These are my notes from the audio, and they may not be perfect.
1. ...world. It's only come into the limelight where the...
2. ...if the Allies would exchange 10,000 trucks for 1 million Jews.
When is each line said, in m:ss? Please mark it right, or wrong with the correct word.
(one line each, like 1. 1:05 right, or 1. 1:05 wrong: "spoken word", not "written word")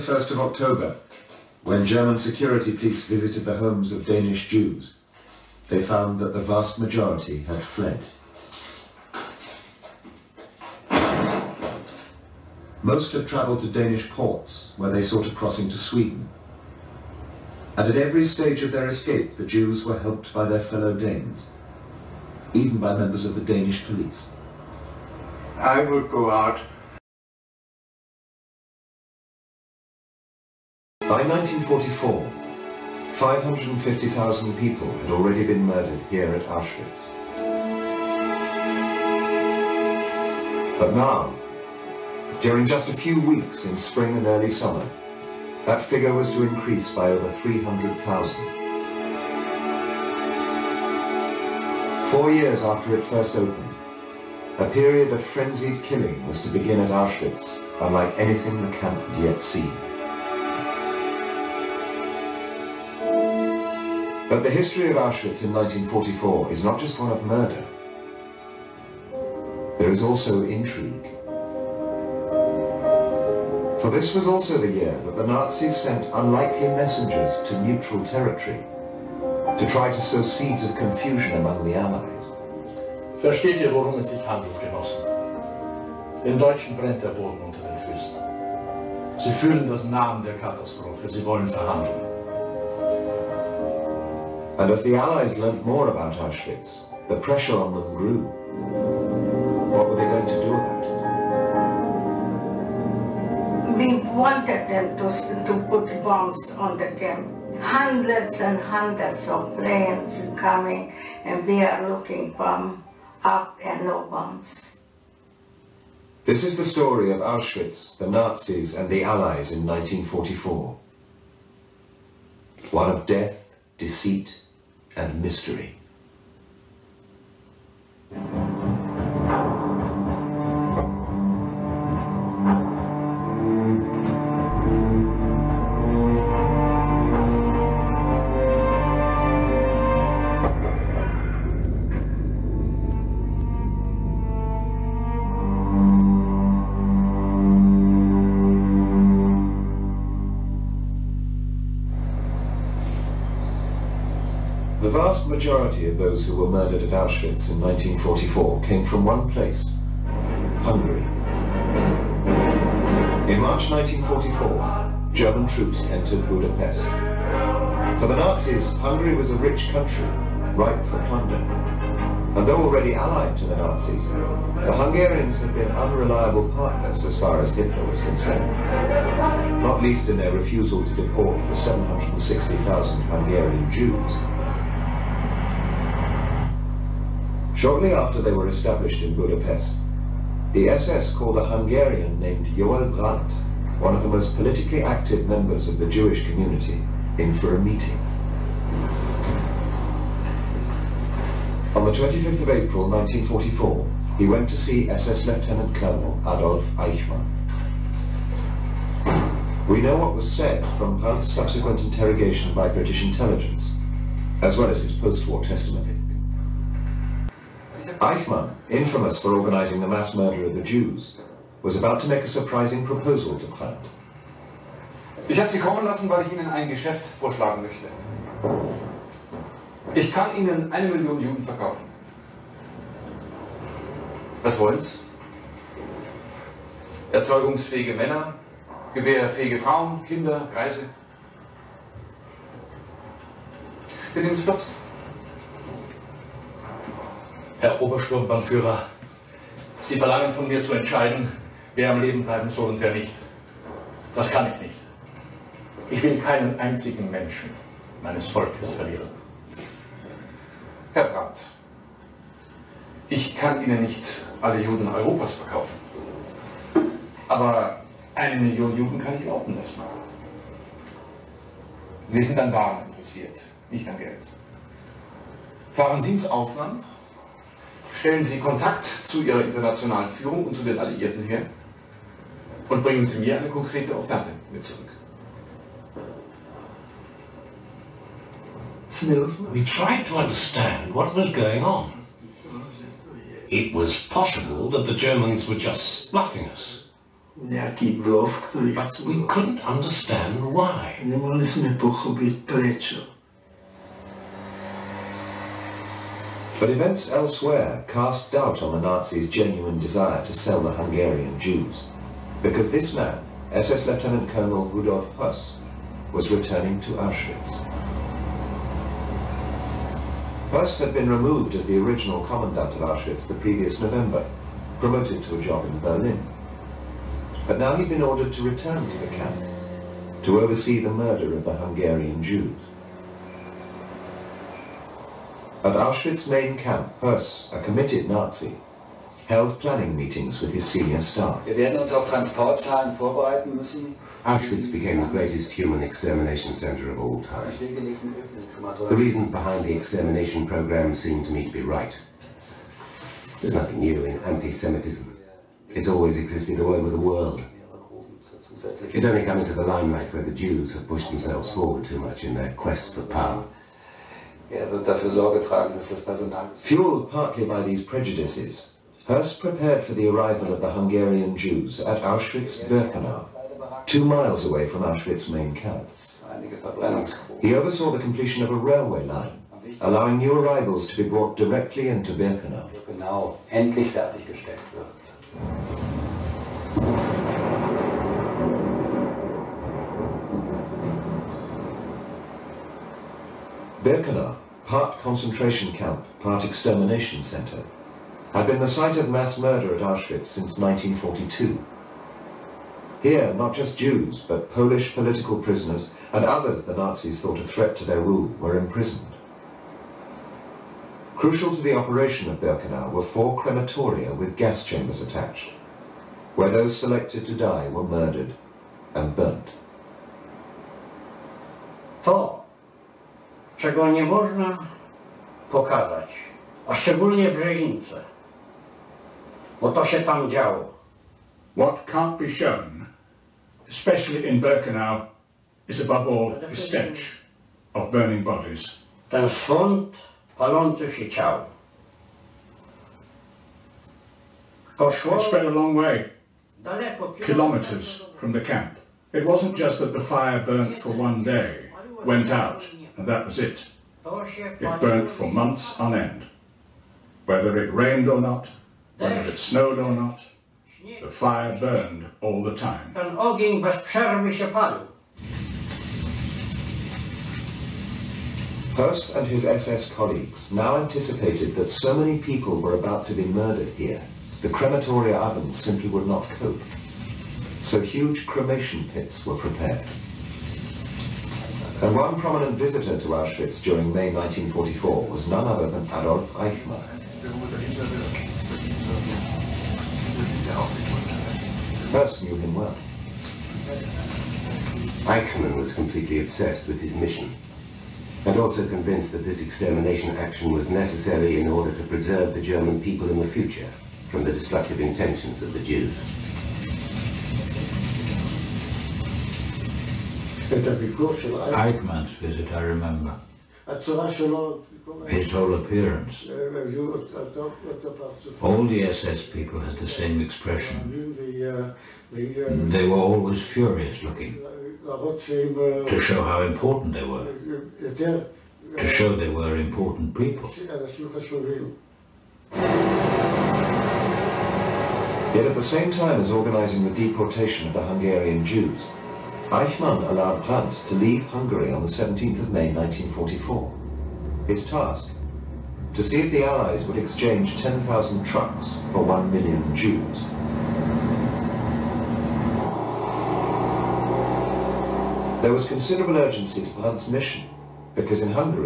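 1. 5:56 right
2. 9:06 right.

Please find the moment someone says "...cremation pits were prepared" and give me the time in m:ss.
7:58.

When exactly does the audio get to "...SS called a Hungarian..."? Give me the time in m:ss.
3:10.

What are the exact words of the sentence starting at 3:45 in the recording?
Ich habe Sie kommen lassen, weil ich Ihnen ein Geschäft vorschlagen möchte.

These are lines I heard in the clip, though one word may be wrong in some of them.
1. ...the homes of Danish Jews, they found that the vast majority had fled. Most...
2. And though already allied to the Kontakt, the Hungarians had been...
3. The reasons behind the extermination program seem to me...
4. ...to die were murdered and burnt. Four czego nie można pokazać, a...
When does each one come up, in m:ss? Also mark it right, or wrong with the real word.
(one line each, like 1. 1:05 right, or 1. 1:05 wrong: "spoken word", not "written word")
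1. 0:03 right
2. 2:52 wrong: "Nazis", not "Kontakt"
3. 5:48 right
4. 6:57 right.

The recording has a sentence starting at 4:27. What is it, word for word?
Aber eine Million Juden kann ich laufen lassen.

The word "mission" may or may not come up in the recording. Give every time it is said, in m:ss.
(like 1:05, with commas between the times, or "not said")
8:16, 9:17.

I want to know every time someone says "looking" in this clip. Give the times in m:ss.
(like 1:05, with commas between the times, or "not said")
1:51, 8:44.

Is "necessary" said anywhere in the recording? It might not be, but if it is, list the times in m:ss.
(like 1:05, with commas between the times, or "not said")
8:20.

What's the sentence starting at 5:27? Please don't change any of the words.
But now he'd been ordered to return to the camp, to oversee the murder of the Hungarian Jews.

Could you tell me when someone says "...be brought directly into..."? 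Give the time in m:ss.
6:20.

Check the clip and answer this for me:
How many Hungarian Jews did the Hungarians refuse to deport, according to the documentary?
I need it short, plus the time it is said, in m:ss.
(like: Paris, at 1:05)
760,000, at 3:01.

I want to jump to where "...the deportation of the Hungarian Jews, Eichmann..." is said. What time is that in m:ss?
8:56.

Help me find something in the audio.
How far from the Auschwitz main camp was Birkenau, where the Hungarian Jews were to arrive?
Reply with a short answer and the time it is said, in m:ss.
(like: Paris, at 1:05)
two miles, at 6:13.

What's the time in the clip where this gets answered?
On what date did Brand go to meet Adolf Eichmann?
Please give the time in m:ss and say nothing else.
3:21.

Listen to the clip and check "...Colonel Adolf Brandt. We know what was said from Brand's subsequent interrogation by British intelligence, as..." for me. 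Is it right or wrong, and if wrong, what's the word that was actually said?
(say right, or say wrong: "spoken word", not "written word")
wrong: "Eichmann", not "Brandt".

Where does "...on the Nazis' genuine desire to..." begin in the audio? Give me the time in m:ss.
5:08.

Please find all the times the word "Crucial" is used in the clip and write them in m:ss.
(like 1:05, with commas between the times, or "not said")
6:51.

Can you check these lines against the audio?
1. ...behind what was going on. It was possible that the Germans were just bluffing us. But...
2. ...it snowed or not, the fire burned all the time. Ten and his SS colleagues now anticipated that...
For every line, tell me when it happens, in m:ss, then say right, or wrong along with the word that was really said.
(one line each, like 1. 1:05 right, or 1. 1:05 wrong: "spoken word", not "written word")
1. 4:50 wrong: "understand", not "behind"
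2. 7:39 right.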